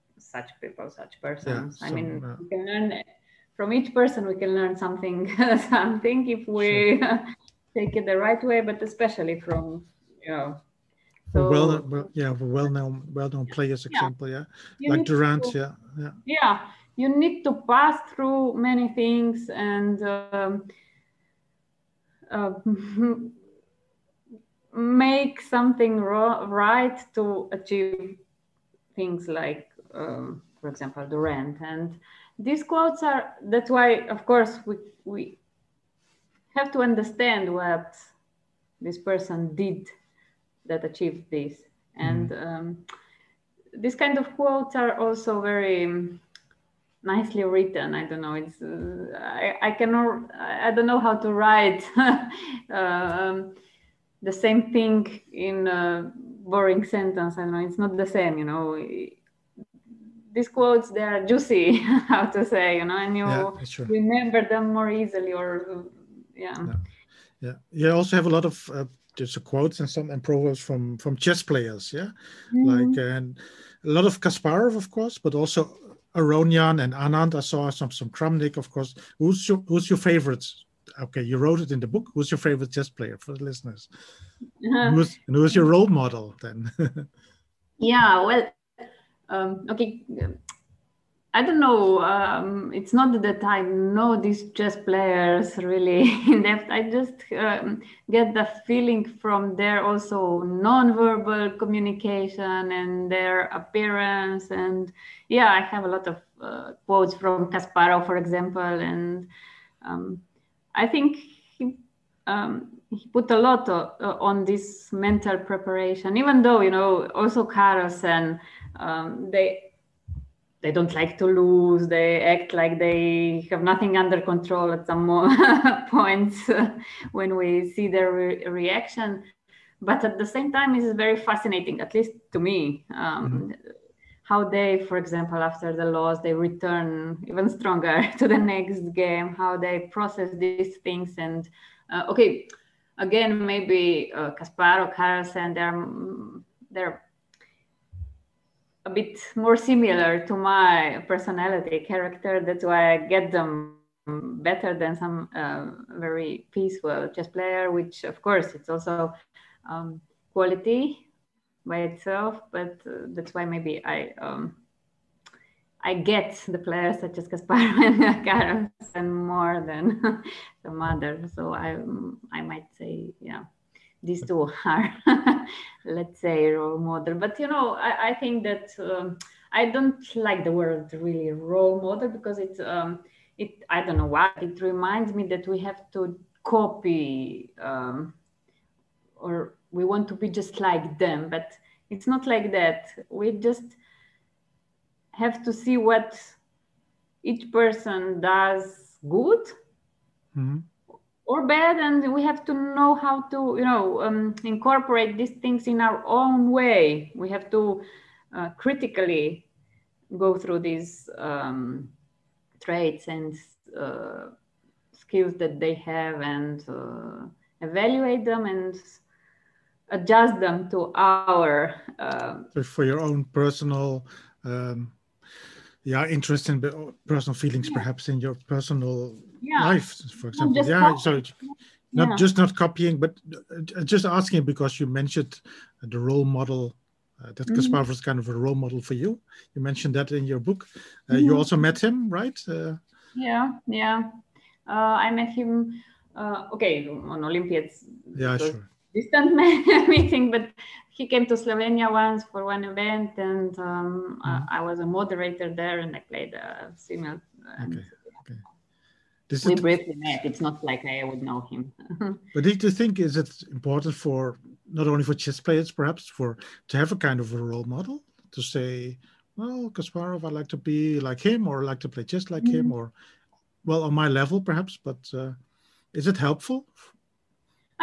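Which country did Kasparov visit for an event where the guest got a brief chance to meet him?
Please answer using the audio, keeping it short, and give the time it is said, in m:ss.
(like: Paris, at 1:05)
Slovenia, at 4:11.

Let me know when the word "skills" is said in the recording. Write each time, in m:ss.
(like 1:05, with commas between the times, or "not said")
3:35.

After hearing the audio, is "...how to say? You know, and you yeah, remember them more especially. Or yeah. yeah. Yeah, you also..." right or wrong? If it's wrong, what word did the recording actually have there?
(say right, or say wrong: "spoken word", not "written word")
wrong: "easily", not "especially".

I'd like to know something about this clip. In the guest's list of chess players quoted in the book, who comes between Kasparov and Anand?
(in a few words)
Aronian.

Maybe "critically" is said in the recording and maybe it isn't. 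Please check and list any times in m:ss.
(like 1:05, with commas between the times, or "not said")
3:28.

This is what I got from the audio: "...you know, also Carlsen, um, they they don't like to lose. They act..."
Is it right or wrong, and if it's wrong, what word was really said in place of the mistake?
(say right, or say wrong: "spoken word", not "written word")
right.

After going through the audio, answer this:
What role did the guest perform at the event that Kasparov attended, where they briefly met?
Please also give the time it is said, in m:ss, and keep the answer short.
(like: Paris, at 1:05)
Moderator, at 4:14.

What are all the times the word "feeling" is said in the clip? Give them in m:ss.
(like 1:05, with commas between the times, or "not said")
1:38, 3:47.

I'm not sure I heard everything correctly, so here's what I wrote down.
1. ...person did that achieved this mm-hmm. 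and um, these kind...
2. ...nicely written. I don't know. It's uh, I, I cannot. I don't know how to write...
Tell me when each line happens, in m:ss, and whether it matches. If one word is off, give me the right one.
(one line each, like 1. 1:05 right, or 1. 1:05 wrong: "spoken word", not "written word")
1. 0:38 right
2. 0:47 right.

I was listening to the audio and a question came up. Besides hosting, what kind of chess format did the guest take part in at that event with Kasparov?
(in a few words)
Simul.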